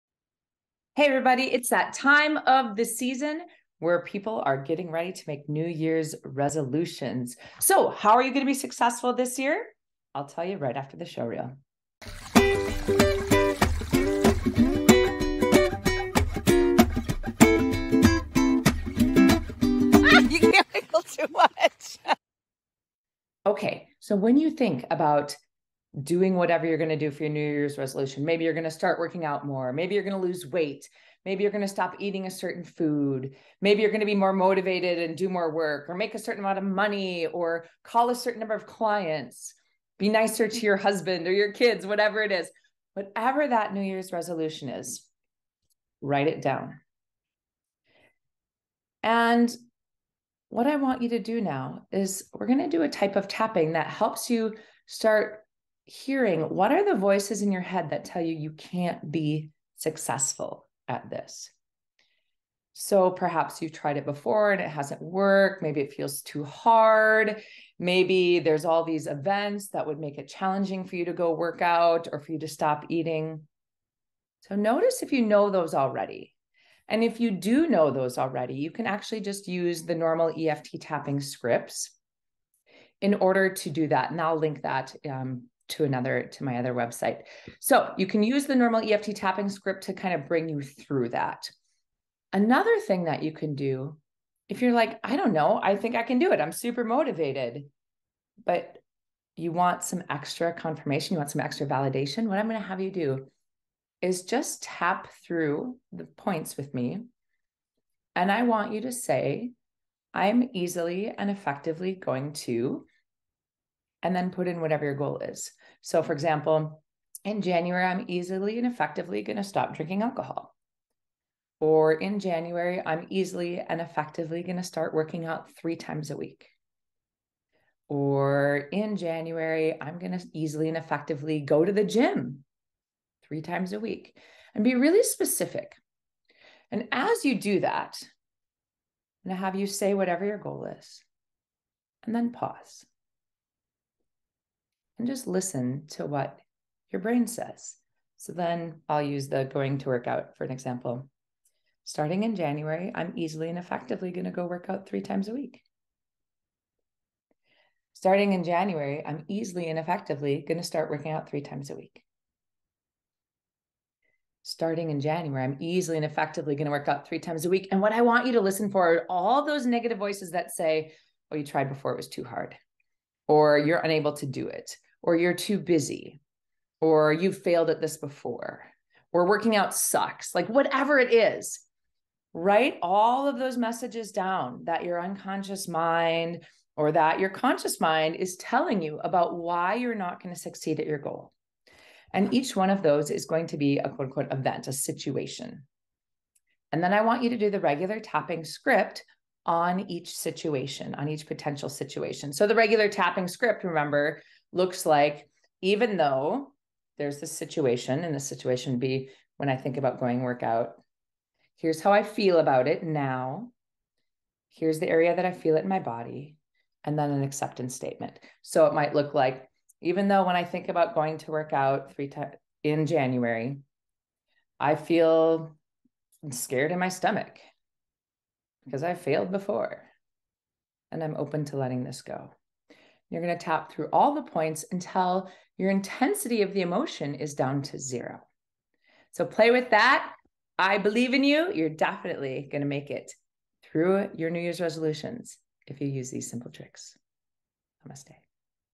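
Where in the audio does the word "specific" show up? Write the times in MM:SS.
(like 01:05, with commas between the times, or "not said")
02:15.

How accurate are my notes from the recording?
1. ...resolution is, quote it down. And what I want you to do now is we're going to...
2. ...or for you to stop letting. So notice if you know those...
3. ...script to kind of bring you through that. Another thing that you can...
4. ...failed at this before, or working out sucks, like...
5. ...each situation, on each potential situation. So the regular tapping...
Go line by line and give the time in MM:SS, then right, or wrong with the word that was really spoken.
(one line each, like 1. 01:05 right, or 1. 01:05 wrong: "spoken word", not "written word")
1. 00:44 wrong: "write", not "quote"
2. 01:12 wrong: "eating", not "letting"
3. 01:29 right
4. 02:57 right
5. 03:19 right.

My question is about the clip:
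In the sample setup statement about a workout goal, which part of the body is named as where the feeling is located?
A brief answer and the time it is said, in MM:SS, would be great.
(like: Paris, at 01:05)
stomach, at 03:46.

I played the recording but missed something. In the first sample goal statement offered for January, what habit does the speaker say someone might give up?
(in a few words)
drinking alcohol.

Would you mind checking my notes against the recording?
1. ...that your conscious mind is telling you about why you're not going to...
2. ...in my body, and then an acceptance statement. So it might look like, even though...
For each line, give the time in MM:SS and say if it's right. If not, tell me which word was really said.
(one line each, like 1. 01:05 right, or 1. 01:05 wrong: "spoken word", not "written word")
1. 03:06 right
2. 03:35 right.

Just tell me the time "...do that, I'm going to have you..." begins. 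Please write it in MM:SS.
02:17.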